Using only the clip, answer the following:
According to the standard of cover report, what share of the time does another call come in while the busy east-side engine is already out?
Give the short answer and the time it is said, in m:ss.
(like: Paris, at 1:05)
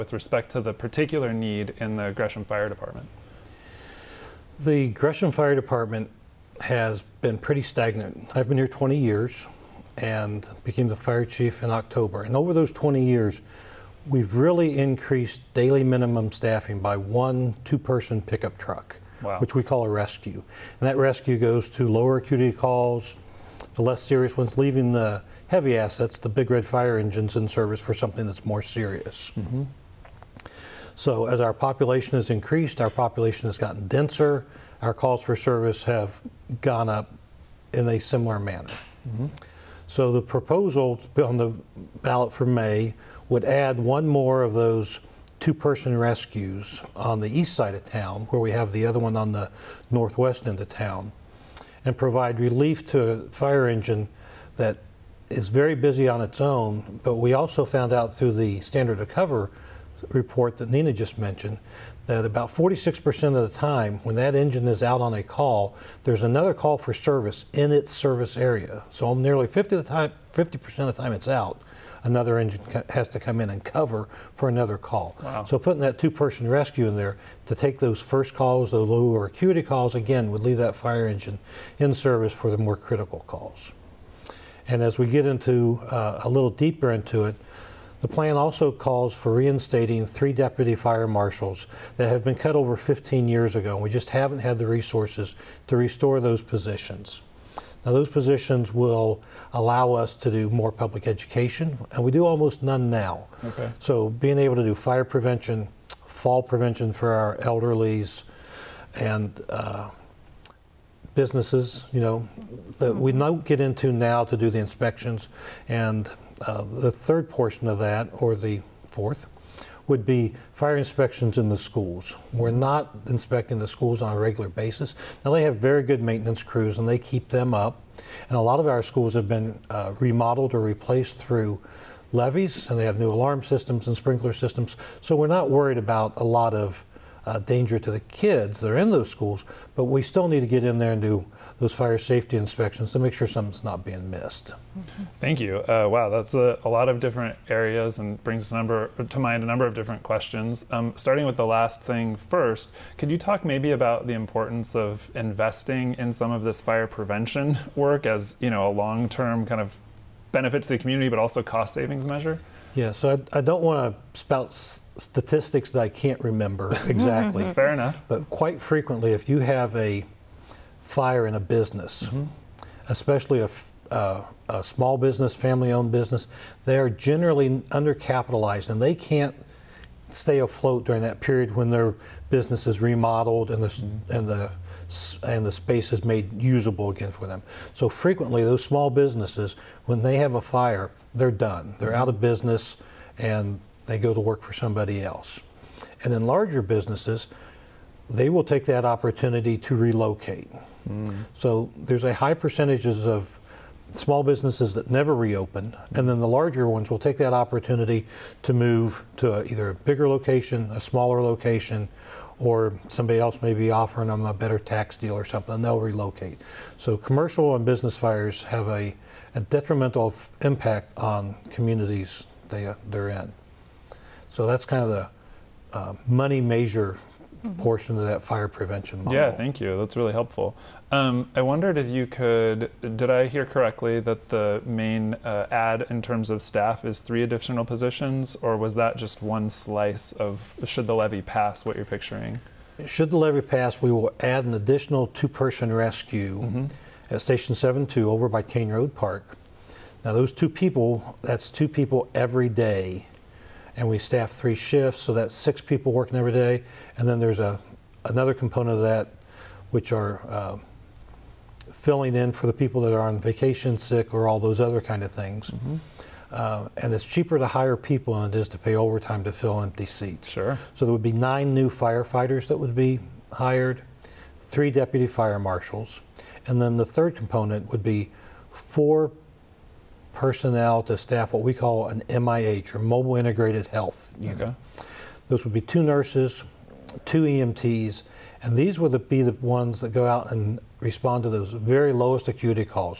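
46%, at 1:02.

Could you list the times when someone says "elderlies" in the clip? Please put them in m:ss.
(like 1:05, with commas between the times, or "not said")
1:47.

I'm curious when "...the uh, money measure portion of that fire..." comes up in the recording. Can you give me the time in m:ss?
3:44.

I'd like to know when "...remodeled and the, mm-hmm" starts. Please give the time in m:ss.
3:02.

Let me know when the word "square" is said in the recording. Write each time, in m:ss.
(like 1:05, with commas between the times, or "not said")
not said.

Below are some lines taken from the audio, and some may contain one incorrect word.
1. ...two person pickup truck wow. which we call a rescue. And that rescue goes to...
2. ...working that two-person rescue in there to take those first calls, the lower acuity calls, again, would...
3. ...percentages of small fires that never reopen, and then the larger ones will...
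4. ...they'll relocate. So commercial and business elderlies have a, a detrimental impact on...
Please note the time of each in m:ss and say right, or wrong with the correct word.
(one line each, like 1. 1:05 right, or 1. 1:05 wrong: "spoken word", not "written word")
1. 0:17 right
2. 1:15 wrong: "putting", not "working"
3. 3:22 wrong: "businesses", not "fires"
4. 3:35 wrong: "fires", not "elderlies".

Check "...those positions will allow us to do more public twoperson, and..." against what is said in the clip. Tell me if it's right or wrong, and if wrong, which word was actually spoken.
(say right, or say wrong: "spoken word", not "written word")
wrong: "education", not "twoperson".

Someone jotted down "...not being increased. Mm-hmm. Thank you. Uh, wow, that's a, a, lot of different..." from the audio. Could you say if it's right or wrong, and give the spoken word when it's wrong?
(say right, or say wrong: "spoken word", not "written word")
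wrong: "missed", not "increased".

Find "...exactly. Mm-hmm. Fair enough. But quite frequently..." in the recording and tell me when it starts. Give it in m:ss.
2:46.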